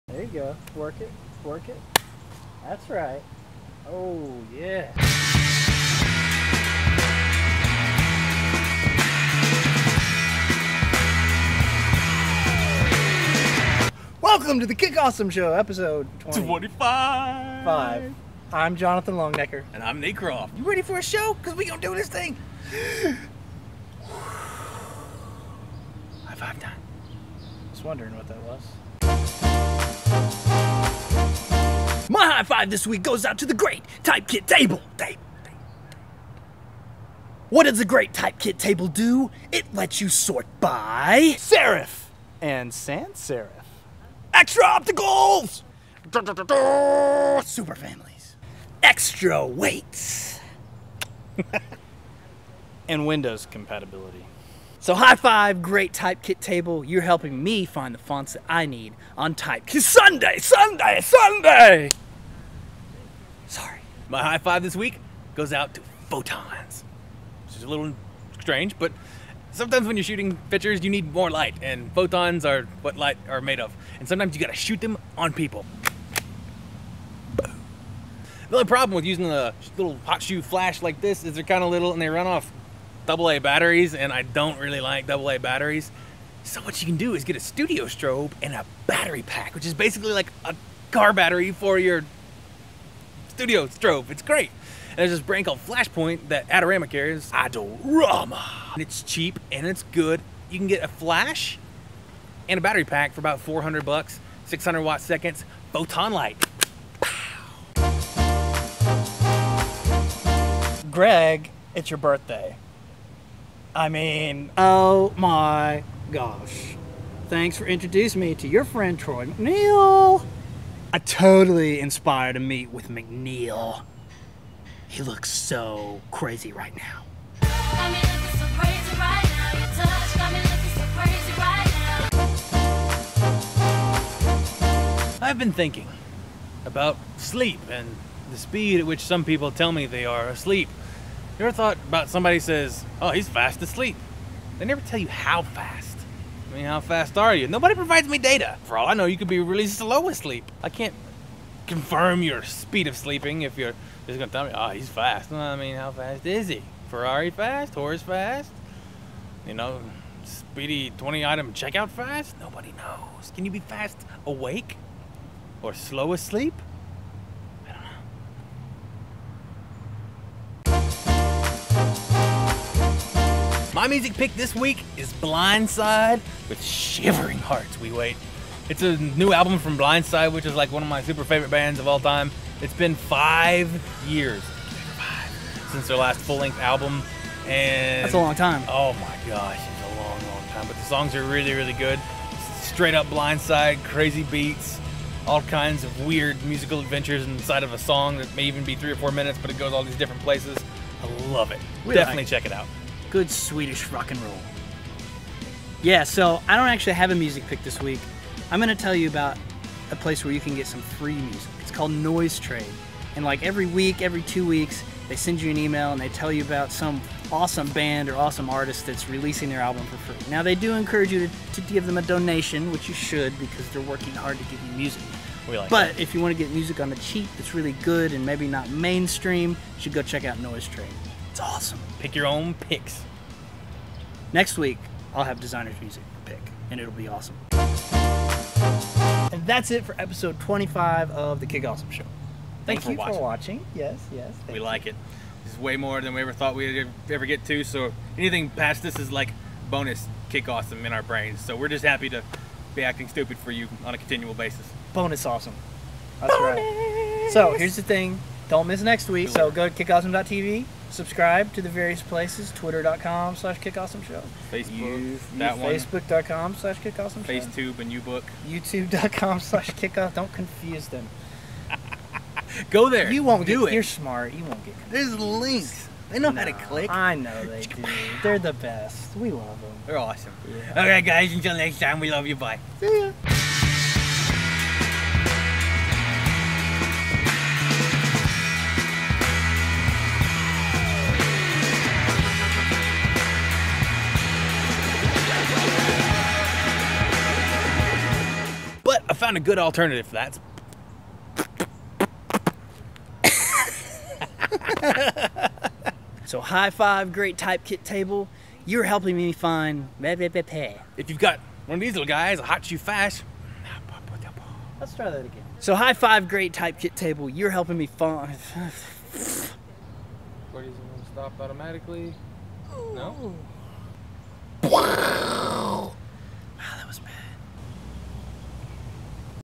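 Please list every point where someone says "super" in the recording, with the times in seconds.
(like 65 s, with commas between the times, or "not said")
47 s, 181 s.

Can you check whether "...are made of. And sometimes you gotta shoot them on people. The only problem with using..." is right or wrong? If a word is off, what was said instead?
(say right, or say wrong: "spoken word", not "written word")
right.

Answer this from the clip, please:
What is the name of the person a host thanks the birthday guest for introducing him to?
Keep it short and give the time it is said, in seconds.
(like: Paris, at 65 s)
Troy McNeil, at 118 s.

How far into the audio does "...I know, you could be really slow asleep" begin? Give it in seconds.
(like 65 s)
148 s.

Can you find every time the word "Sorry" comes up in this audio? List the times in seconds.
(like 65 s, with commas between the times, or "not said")
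63 s.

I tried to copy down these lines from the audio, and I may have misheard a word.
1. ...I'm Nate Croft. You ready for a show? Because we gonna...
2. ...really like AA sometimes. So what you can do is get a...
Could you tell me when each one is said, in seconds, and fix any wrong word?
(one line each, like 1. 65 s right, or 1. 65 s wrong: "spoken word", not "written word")
1. 19 s right
2. 84 s wrong: "batteries", not "sometimes".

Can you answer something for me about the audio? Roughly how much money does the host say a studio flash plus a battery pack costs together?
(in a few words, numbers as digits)
$400.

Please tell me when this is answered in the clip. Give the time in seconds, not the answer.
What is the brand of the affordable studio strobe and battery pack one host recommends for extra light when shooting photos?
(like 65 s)
95 s.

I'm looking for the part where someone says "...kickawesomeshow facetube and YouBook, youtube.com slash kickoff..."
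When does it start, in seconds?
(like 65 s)
266 s.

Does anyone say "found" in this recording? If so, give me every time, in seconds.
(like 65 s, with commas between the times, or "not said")
299 s.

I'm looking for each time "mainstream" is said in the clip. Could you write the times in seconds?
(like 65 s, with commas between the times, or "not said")
228 s.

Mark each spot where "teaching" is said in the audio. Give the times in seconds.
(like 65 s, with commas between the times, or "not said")
not said.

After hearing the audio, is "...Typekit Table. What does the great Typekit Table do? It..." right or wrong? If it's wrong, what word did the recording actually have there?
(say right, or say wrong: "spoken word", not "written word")
right.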